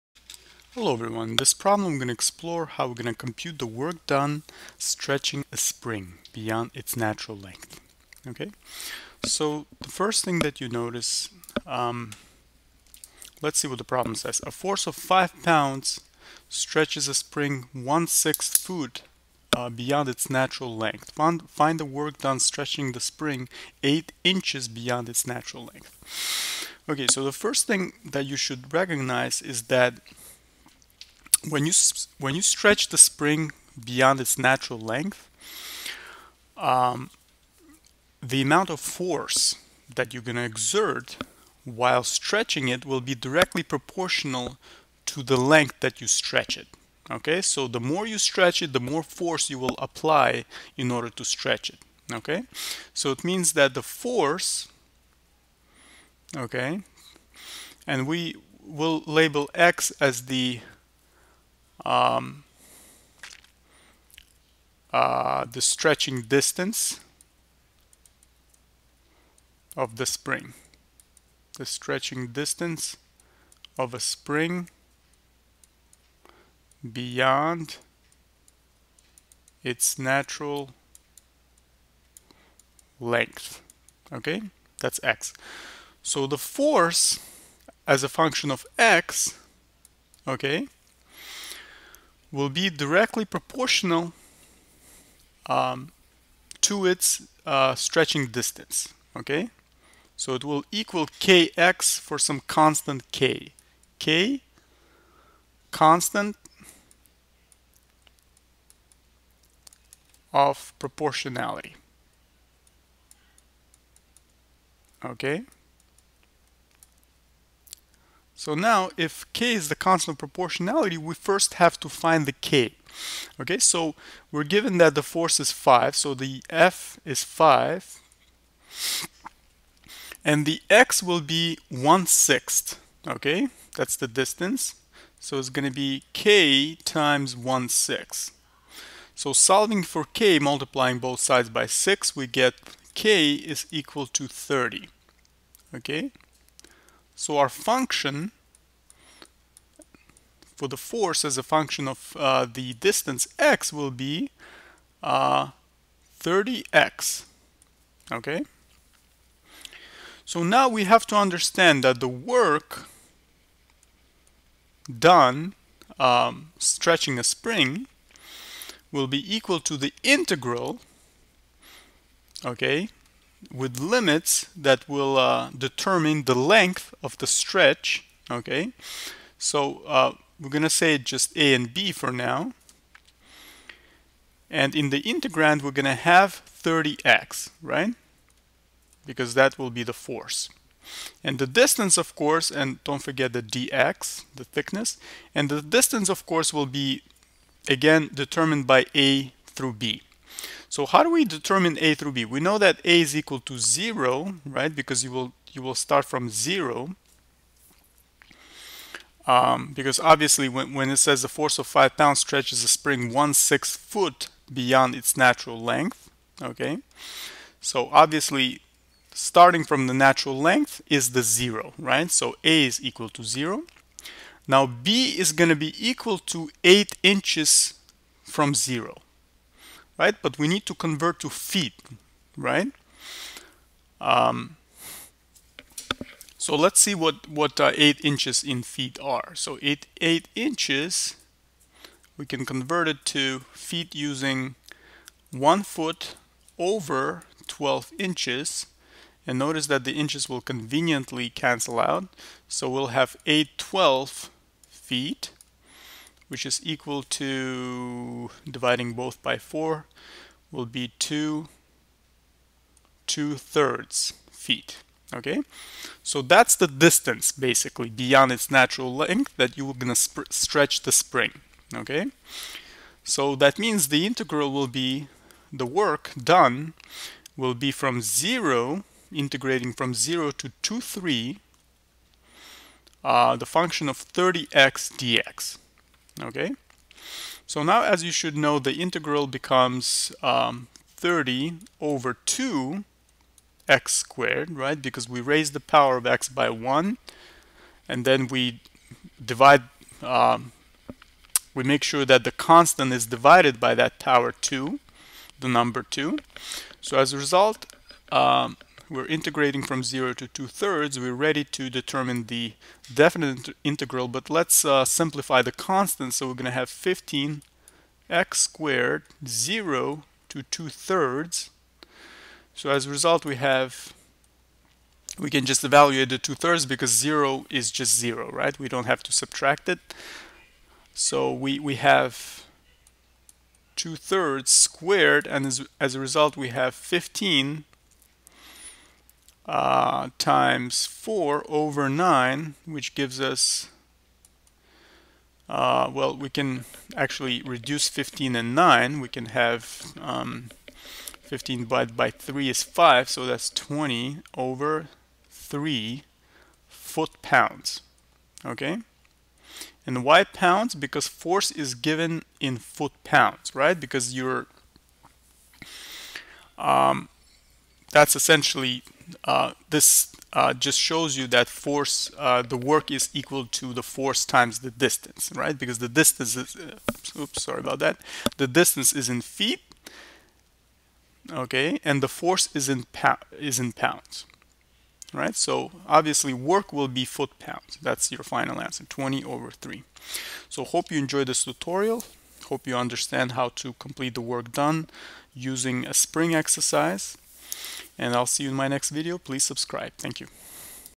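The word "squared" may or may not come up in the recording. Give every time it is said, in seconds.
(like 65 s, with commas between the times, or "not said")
293 s, 318 s, 334 s.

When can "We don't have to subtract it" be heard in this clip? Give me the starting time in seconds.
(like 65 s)
328 s.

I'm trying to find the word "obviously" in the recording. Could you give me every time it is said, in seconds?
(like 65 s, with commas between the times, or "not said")
209 s, 217 s, 385 s.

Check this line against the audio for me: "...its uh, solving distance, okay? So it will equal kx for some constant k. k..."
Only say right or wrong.
wrong.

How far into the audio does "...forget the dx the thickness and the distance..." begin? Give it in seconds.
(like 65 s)
193 s.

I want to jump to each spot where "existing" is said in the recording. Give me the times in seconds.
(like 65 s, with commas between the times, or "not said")
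not said.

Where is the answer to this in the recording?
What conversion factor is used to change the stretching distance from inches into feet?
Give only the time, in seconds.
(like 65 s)
245 s.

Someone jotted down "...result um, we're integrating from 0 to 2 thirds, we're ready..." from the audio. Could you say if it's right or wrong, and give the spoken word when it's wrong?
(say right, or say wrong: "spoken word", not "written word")
right.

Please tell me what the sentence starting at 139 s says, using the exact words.
So solving for K, multiplying both sides by 6, we get K is equal to 30, okay.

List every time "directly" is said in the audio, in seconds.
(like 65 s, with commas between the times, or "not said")
43 s, 92 s.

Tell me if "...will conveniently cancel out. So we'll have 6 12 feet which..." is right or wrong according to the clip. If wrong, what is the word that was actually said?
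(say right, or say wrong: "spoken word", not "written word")
wrong: "8", not "6".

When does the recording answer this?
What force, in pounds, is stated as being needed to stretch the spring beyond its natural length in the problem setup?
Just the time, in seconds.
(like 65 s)
14 s.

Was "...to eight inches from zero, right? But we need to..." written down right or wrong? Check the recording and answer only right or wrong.
right.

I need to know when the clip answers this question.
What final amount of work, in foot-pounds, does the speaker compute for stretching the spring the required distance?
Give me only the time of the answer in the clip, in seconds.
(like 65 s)
353 s.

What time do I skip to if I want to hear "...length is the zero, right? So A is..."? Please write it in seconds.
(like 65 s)
220 s.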